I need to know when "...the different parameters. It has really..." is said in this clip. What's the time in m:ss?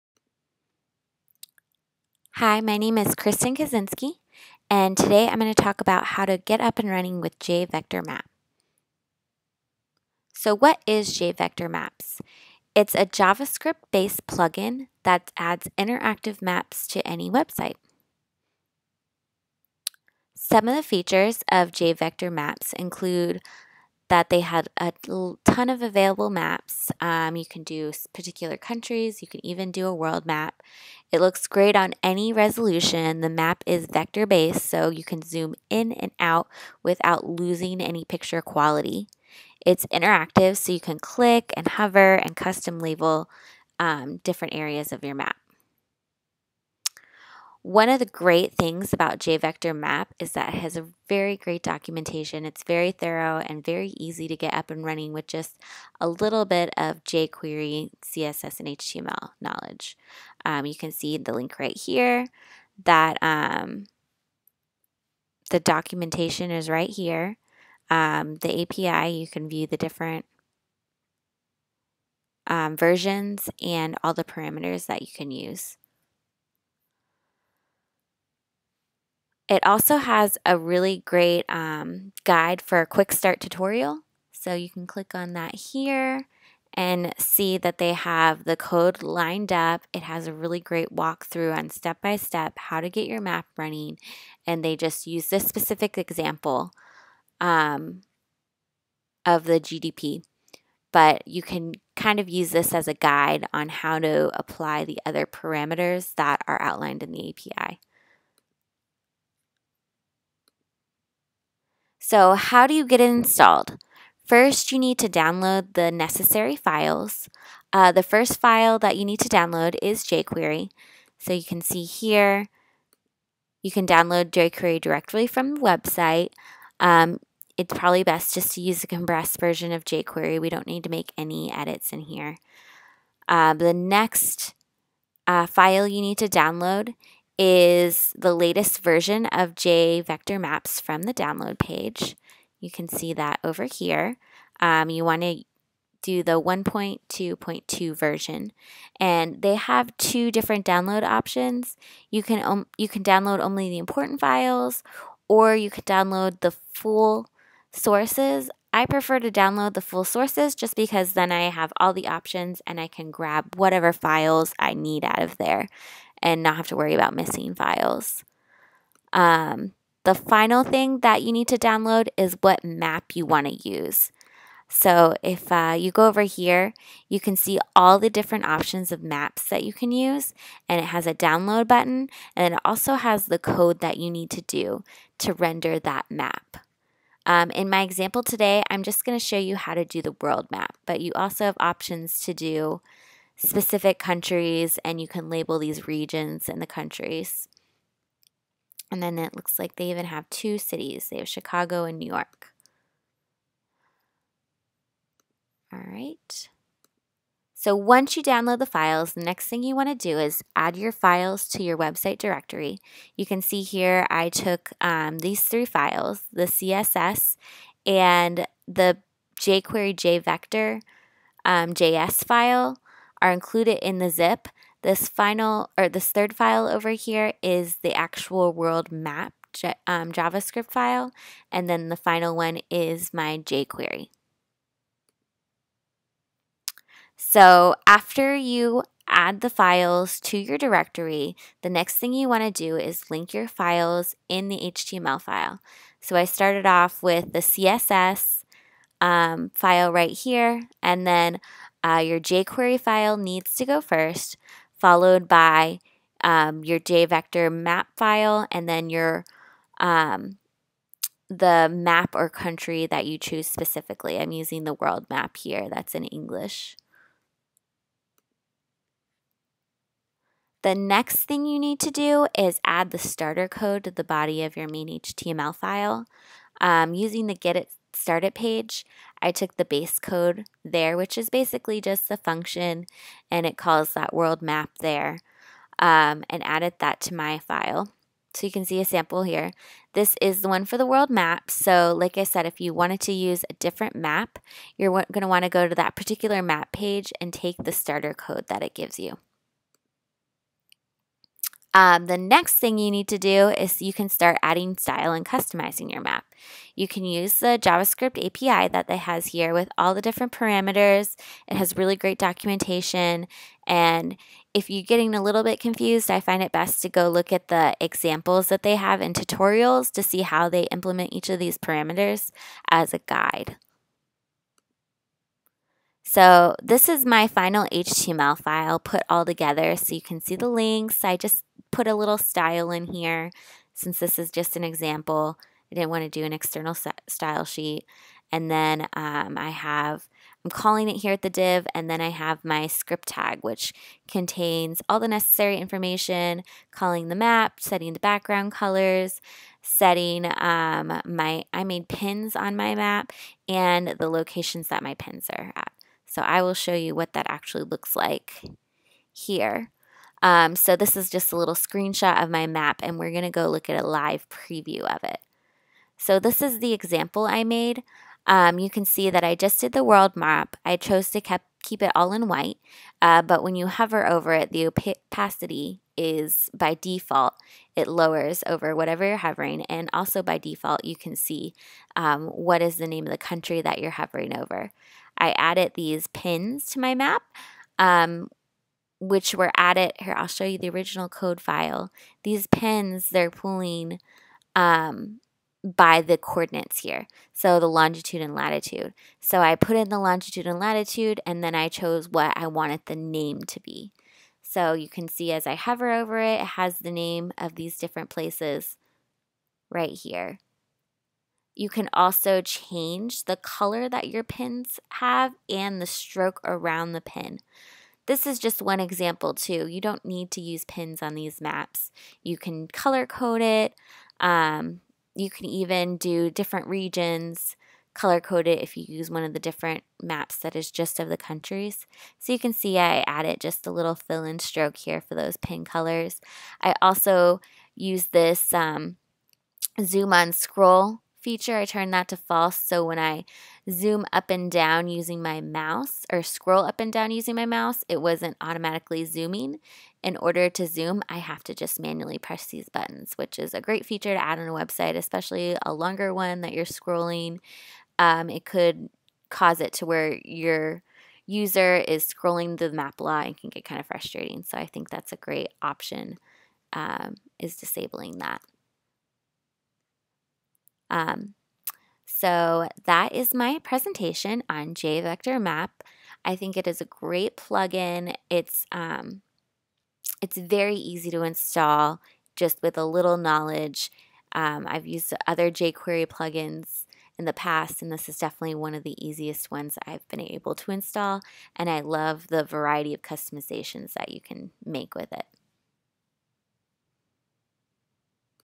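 5:09.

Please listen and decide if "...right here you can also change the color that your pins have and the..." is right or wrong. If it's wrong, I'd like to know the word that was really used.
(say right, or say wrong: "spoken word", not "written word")
right.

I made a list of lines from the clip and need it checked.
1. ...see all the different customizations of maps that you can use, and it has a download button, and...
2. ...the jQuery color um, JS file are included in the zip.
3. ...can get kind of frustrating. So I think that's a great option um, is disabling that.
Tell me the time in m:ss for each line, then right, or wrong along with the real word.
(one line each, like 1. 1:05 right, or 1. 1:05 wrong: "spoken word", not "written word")
1. 2:57 wrong: "options", not "customizations"
2. 3:38 wrong: "jvector", not "color"
3. 7:43 right.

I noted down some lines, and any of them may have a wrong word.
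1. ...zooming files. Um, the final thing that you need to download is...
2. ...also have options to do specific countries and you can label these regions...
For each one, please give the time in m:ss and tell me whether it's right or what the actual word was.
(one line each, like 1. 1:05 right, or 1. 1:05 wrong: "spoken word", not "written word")
1. 2:47 wrong: "missing", not "zooming"
2. 3:11 right.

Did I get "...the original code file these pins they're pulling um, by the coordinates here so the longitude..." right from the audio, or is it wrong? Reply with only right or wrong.
right.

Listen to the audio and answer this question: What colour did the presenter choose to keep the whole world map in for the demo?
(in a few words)
White.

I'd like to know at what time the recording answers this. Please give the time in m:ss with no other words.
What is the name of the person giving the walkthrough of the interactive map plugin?
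0:03.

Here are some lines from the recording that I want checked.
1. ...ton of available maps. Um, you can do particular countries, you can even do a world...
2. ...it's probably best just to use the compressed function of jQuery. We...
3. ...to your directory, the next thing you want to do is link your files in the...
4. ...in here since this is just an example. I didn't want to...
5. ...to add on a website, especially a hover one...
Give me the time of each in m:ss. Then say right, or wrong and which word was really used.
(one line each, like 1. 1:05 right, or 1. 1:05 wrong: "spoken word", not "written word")
1. 0:25 right
2. 2:07 wrong: "version", not "function"
3. 4:00 right
4. 5:32 right
5. 7:34 wrong: "longer", not "hover".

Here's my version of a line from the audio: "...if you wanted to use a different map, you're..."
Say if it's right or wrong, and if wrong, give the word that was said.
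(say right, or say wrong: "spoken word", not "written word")
right.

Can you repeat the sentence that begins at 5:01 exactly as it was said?
Um, the next thing you need to do is you can start adding style and customizing your map.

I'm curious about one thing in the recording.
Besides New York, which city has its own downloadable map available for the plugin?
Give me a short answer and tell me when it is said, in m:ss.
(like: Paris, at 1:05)
Chicago, at 3:21.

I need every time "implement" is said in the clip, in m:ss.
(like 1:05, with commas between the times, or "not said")
5:20.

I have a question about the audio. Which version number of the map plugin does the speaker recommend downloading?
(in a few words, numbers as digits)
1.2.2.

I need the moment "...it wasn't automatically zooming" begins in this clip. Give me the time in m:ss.
7:27.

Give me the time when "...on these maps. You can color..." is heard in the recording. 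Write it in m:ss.
7:01.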